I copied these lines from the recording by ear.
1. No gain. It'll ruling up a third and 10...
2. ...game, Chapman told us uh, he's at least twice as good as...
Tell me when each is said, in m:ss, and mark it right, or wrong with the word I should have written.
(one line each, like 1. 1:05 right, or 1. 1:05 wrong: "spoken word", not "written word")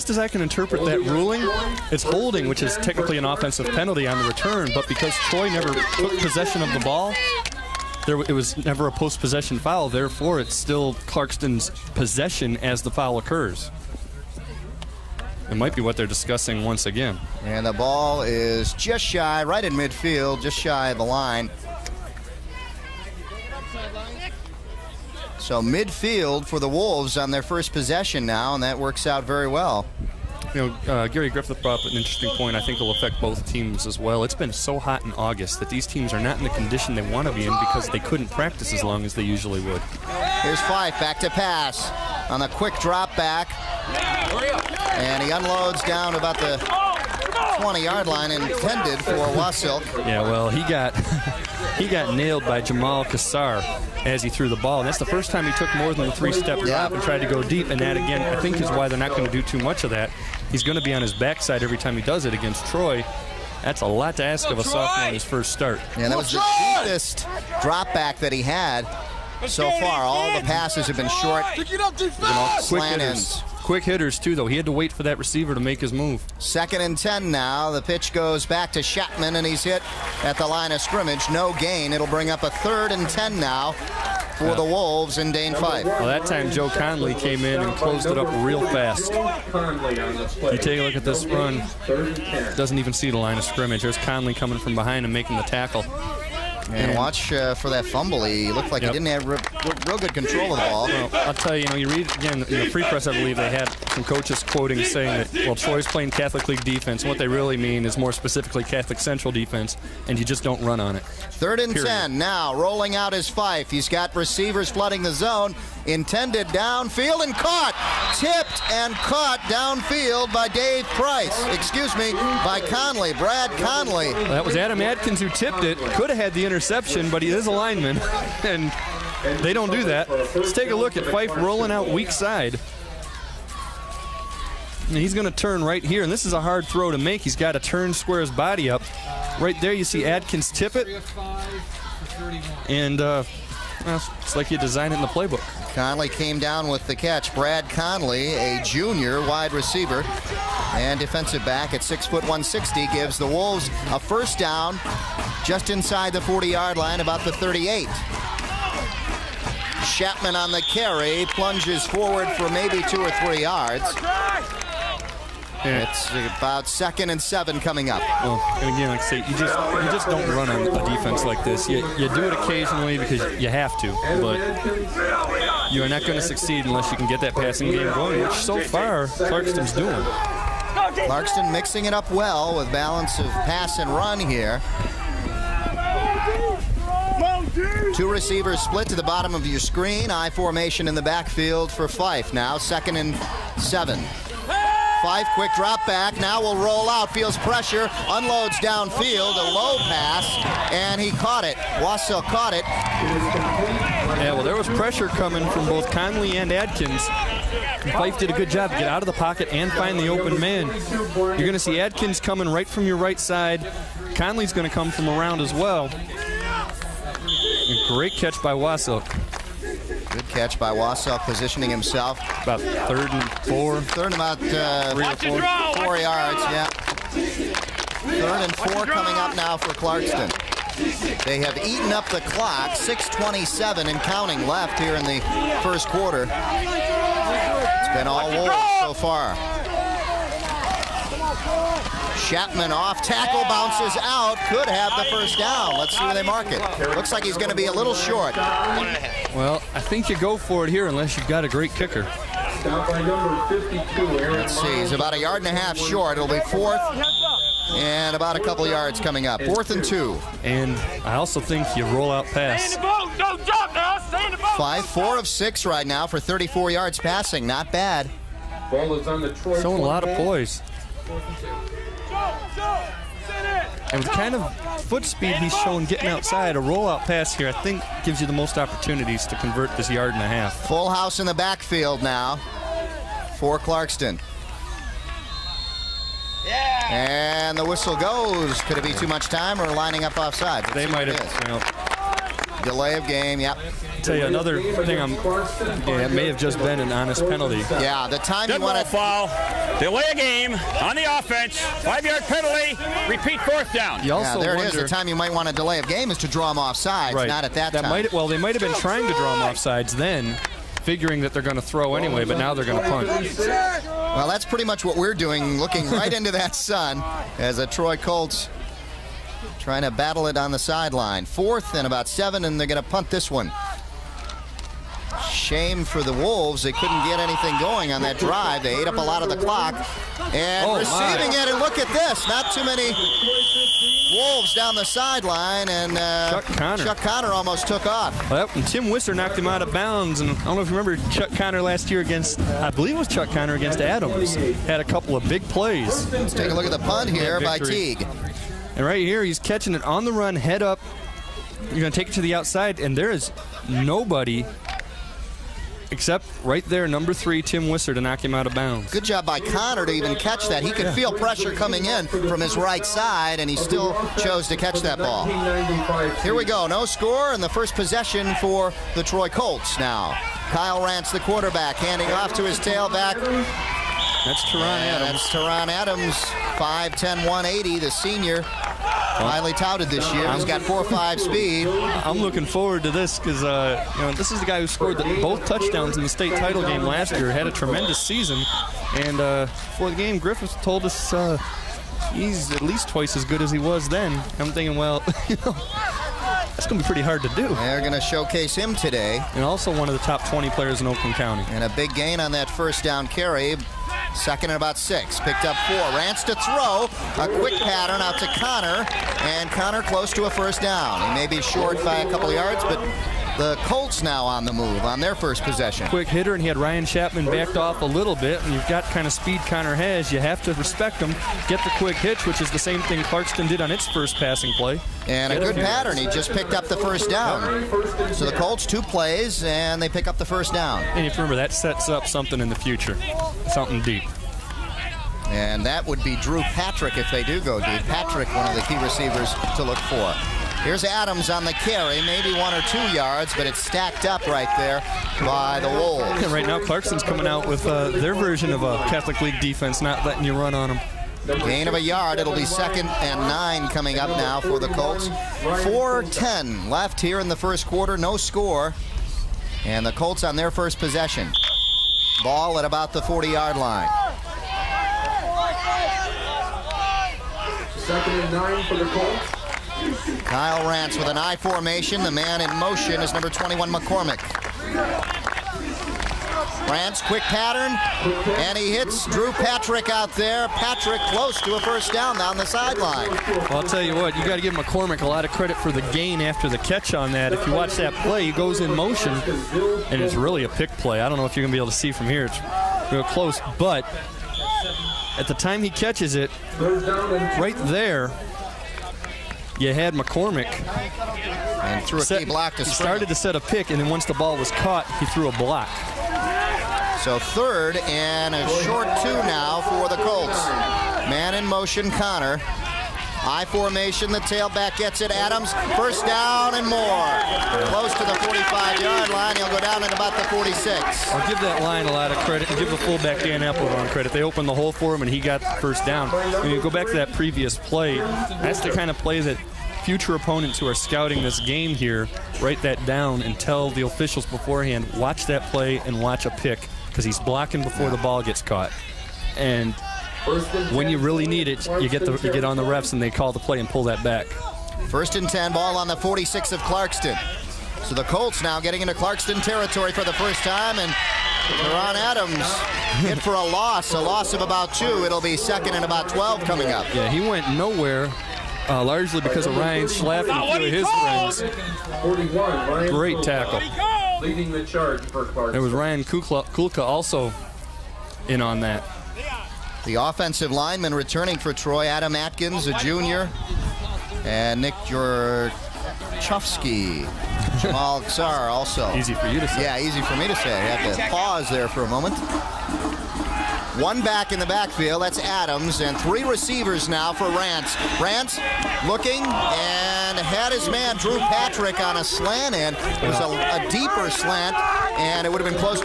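1. 1:21 wrong: "bring", not "ruling"
2. 6:29 wrong: "Griffiths", not "Chapman".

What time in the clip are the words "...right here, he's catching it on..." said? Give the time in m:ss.
5:48.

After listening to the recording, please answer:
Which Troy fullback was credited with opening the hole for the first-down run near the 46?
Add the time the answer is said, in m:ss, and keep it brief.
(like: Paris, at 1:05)
Dan Appledorn, at 8:43.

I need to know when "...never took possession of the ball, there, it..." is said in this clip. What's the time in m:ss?
0:05.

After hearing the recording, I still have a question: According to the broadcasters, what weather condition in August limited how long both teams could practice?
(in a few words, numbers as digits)
Hot.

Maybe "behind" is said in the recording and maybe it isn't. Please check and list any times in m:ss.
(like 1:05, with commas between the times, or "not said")
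1:34.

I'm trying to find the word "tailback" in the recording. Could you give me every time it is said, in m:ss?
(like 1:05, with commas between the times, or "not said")
6:12, 8:34.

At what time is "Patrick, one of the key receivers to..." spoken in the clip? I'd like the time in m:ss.
7:17.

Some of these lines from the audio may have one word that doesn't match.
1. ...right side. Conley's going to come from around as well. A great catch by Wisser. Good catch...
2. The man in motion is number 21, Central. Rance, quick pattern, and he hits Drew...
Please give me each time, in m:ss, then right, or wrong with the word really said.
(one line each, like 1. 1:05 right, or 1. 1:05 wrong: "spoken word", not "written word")
1. 3:32 wrong: "Wasilk", not "Wisser"
2. 7:52 wrong: "McCormick", not "Central".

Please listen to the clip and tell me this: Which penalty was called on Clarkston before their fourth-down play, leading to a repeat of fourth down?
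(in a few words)
Delay of game.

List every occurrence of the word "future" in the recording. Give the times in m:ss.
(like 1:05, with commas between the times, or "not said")
7:12, 8:49.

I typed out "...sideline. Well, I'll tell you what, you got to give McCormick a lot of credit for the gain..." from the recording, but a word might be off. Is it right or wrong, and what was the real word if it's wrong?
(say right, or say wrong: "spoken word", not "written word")
right.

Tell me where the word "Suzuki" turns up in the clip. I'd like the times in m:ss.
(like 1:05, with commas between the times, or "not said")
not said.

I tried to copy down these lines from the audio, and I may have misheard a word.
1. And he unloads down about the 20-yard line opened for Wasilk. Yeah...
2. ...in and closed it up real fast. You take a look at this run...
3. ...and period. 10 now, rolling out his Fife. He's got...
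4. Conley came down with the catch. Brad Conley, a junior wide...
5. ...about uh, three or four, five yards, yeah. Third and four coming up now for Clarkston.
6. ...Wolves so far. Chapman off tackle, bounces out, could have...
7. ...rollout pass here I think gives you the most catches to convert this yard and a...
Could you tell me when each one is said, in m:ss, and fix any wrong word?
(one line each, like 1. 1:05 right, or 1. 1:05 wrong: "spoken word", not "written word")
1. 0:44 wrong: "intended", not "opened"
2. 1:27 right
3. 1:51 right
4. 2:25 right
5. 3:44 wrong: "four", not "five"
6. 3:58 right
7. 4:36 wrong: "opportunities", not "catches".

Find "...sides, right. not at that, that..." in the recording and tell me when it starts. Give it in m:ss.
5:06.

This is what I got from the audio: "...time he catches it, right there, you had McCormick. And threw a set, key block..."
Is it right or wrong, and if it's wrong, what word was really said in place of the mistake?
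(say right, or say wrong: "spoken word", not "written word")
right.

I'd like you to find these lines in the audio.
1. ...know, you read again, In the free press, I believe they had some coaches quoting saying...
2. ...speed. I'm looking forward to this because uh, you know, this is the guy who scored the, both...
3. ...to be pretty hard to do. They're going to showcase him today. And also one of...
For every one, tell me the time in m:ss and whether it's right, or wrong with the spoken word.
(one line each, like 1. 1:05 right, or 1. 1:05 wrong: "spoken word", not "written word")
1. 1:41 right
2. 6:21 right
3. 6:36 right.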